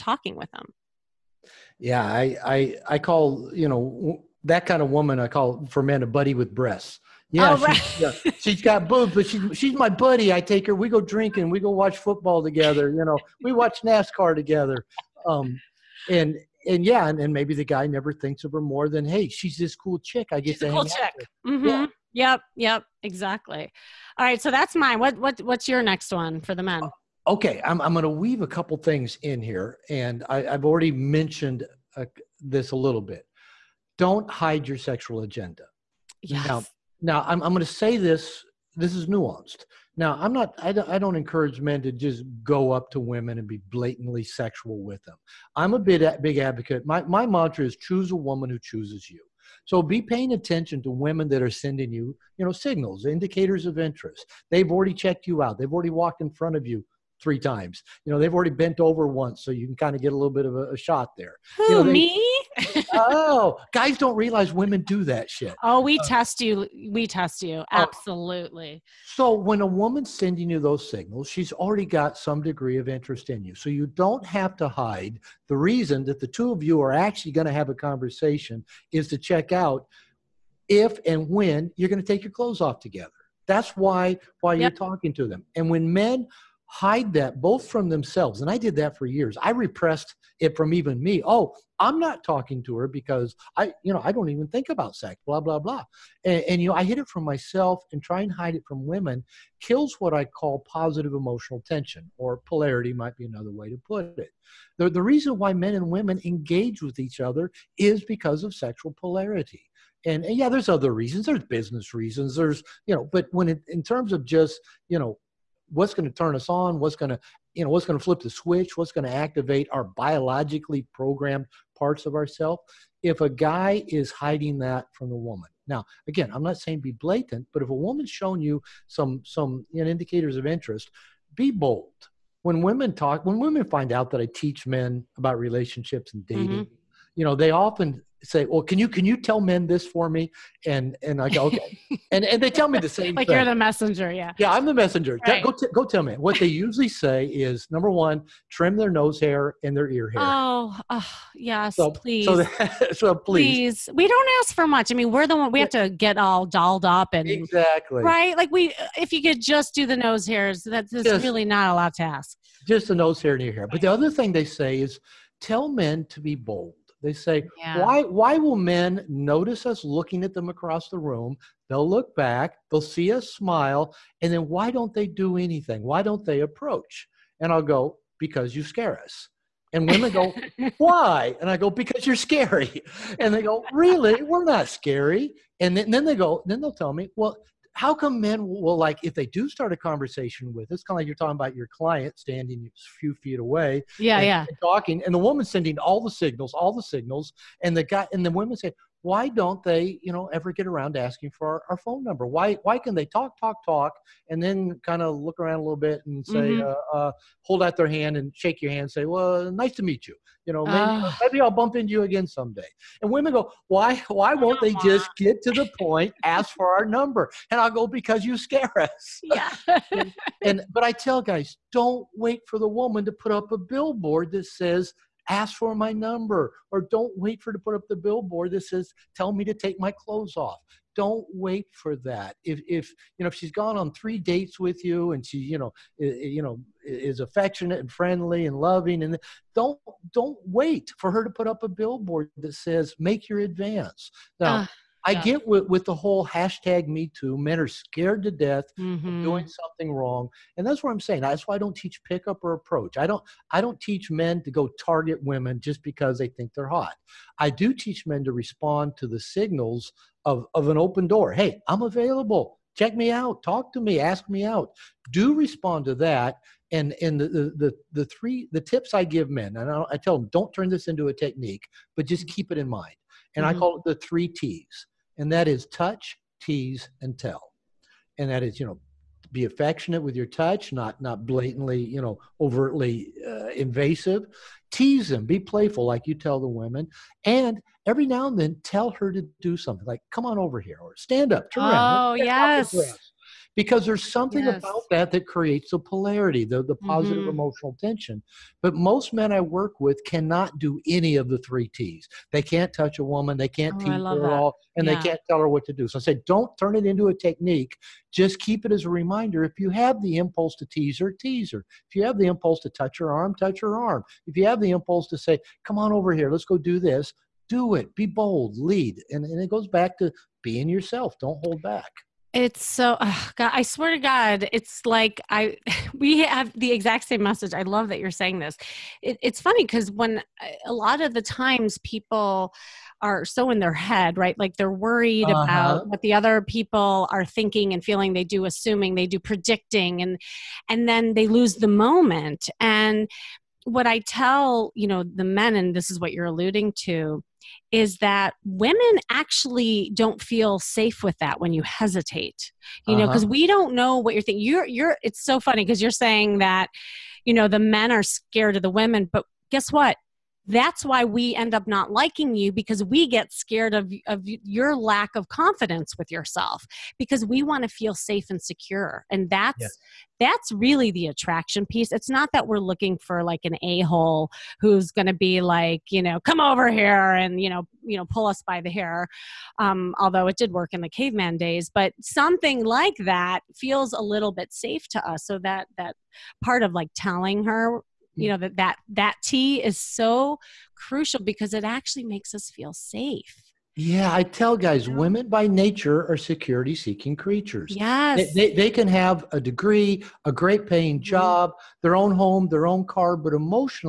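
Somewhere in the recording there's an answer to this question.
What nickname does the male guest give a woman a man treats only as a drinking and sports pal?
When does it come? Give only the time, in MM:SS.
00:06.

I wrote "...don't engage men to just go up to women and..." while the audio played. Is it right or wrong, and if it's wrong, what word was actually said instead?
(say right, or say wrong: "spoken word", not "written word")
wrong: "encourage", not "engage".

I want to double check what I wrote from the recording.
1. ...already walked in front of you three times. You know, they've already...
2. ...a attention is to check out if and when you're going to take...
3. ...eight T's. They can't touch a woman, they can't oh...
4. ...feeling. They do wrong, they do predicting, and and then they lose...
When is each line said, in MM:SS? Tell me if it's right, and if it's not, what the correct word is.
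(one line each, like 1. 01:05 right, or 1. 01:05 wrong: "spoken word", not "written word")
1. 00:55 right
2. 01:17 wrong: "conversation", not "attention"
3. 05:01 wrong: "three", not "eight"
4. 05:37 wrong: "assuming", not "wrong".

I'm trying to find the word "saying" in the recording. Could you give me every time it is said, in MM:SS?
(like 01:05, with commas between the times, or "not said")
02:06, 04:10, 05:28, 05:55.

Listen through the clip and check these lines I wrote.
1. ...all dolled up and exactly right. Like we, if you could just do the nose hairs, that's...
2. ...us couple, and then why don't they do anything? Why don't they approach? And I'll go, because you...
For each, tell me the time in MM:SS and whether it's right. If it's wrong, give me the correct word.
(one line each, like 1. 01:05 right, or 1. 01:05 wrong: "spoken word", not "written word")
1. 02:36 right
2. 02:53 wrong: "smile", not "couple".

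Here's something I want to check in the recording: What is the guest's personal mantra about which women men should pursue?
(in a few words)
choose a woman who chooses you.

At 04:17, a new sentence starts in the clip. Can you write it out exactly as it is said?
I do teach men to respond to the signals of of an open door.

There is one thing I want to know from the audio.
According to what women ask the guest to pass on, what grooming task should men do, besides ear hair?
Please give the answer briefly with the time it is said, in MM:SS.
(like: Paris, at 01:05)
trim their nose hair, at 02:28.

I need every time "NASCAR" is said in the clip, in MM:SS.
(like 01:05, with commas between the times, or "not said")
00:13.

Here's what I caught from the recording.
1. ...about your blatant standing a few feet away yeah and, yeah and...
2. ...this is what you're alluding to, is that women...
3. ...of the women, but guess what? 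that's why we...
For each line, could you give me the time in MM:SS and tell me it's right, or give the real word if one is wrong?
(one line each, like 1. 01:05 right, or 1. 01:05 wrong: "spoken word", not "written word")
1. 03:11 wrong: "client", not "blatant"
2. 05:45 right
3. 05:58 right.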